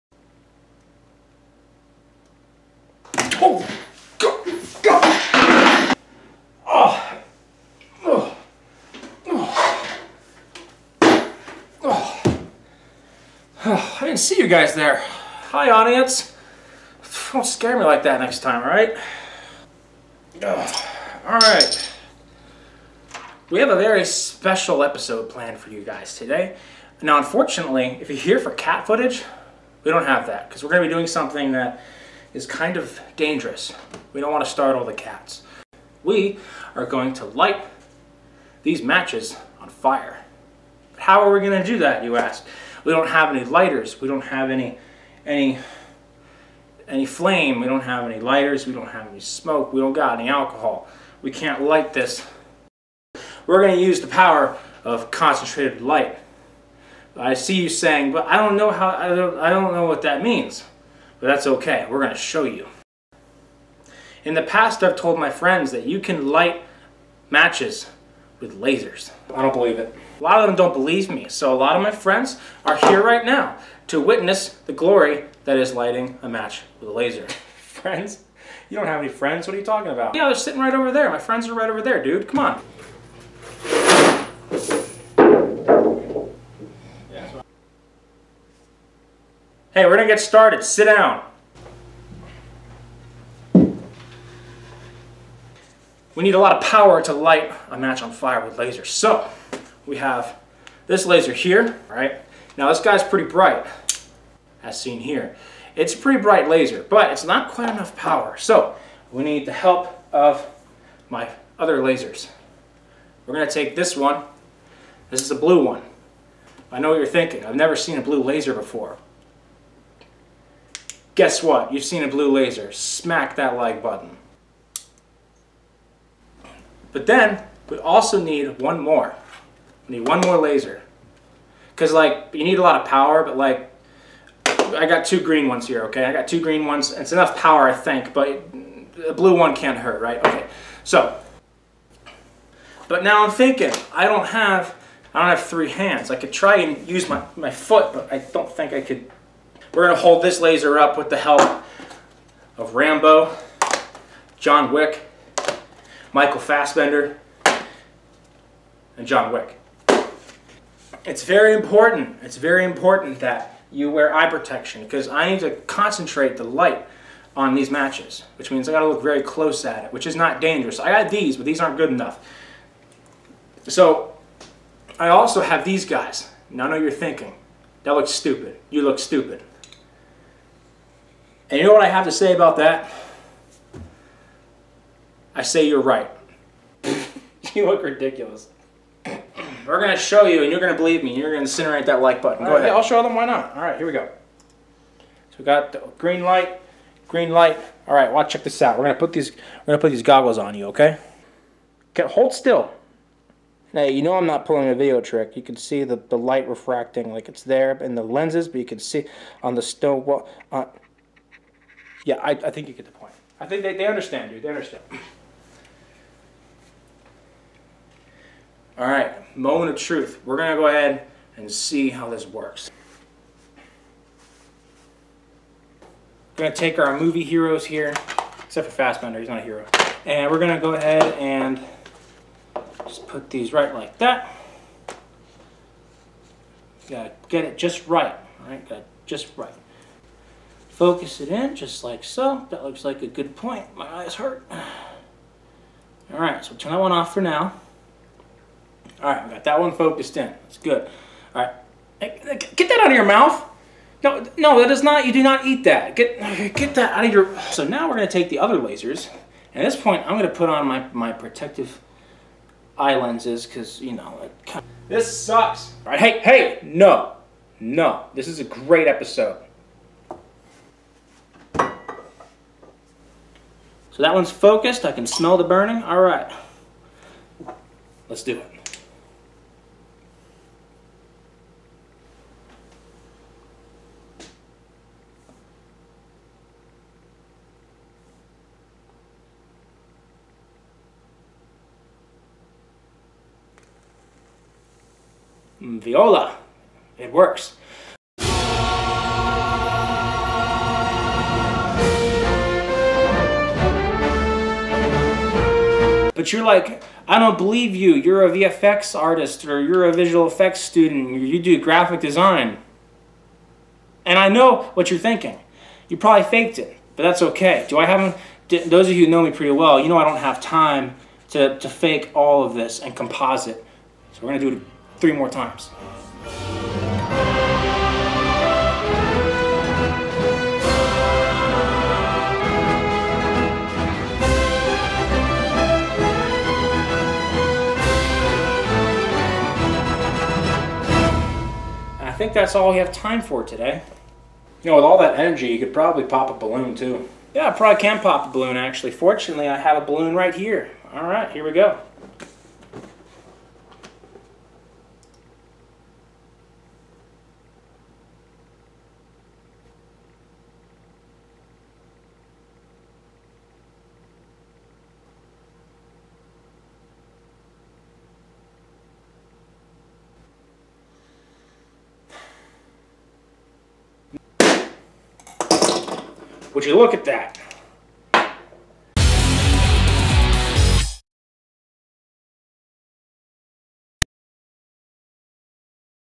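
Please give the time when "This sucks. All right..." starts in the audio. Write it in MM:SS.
04:24.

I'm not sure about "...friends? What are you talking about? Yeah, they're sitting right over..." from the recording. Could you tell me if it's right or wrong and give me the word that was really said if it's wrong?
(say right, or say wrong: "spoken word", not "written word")
right.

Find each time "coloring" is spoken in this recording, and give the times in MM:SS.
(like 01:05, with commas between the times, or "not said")
not said.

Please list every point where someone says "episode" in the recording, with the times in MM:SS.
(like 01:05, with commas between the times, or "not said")
00:24, 04:28.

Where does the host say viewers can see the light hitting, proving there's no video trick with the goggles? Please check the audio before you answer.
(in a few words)
Stone wall.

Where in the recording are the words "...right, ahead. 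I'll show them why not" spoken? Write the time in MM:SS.
03:12.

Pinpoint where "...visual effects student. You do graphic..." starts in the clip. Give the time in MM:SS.
05:09.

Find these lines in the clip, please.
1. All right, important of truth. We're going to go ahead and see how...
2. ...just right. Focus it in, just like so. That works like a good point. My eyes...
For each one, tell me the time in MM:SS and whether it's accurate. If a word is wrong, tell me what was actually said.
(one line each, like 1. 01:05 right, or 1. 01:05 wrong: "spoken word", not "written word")
1. 03:38 wrong: "moment", not "important"
2. 03:59 wrong: "looks", not "works".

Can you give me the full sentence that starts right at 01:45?
It's a pretty bright laser, but it's not quite enough power.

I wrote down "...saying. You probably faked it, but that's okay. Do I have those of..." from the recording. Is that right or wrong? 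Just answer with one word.
wrong.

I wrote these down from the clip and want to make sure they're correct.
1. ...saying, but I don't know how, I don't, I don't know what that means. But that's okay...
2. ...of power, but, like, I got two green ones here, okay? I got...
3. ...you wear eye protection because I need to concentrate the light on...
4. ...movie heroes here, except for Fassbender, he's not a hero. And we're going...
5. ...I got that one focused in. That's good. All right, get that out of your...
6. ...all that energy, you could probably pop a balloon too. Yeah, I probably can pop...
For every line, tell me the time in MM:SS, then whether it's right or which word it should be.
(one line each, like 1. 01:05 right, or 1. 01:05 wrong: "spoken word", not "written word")
1. 00:57 right
2. 02:12 right
3. 02:43 right
4. 03:46 right
5. 04:09 right
6. 05:44 right.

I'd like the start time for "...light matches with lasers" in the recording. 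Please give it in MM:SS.
01:06.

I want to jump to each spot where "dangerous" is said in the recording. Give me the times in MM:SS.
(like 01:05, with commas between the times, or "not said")
00:33, 02:50.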